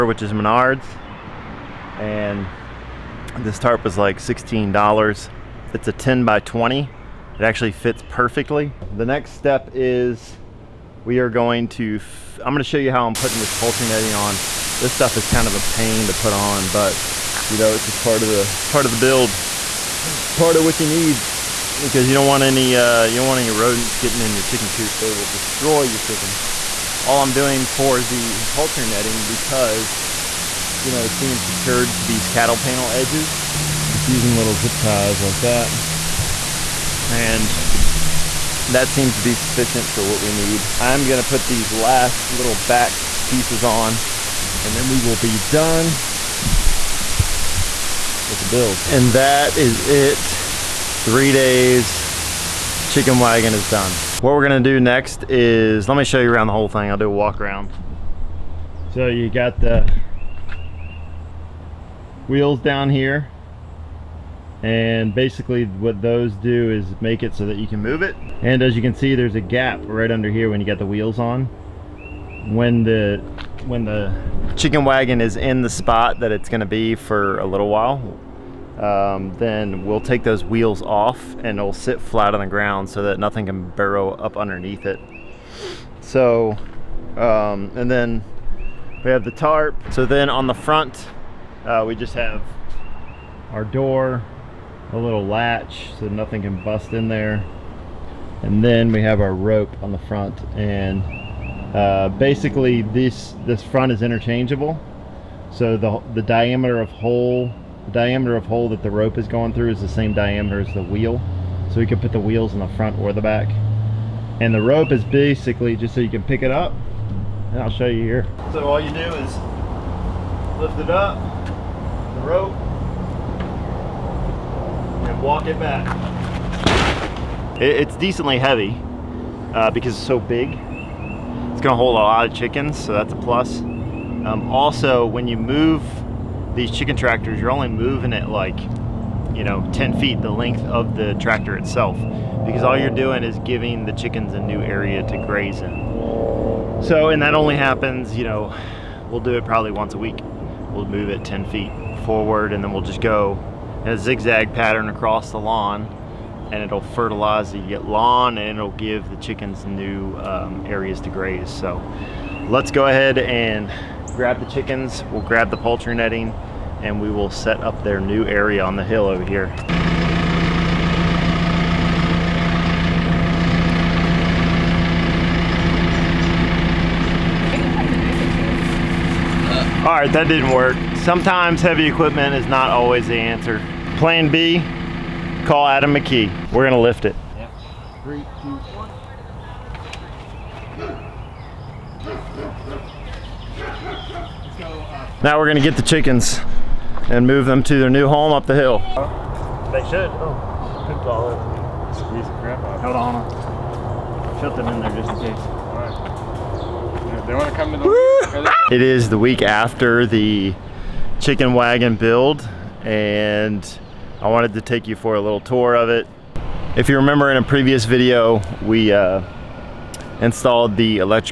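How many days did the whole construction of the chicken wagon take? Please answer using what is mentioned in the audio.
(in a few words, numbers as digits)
3.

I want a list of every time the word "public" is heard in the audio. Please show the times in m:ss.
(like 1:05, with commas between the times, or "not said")
not said.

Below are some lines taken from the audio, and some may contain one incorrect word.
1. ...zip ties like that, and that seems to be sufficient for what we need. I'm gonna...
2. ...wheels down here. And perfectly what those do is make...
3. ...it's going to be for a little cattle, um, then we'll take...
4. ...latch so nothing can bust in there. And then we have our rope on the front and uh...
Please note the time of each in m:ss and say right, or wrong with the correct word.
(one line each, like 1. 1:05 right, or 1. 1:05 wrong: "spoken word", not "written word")
1. 0:34 right
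2. 1:02 wrong: "basically", not "perfectly"
3. 1:16 wrong: "while", not "cattle"
4. 1:35 right.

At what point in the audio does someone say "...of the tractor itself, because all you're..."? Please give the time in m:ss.
2:20.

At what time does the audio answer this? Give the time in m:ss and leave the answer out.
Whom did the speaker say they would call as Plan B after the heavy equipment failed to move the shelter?
3:05.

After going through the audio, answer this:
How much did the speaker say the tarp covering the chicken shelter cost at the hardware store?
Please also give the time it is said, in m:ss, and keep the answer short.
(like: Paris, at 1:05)
$16, at 0:04.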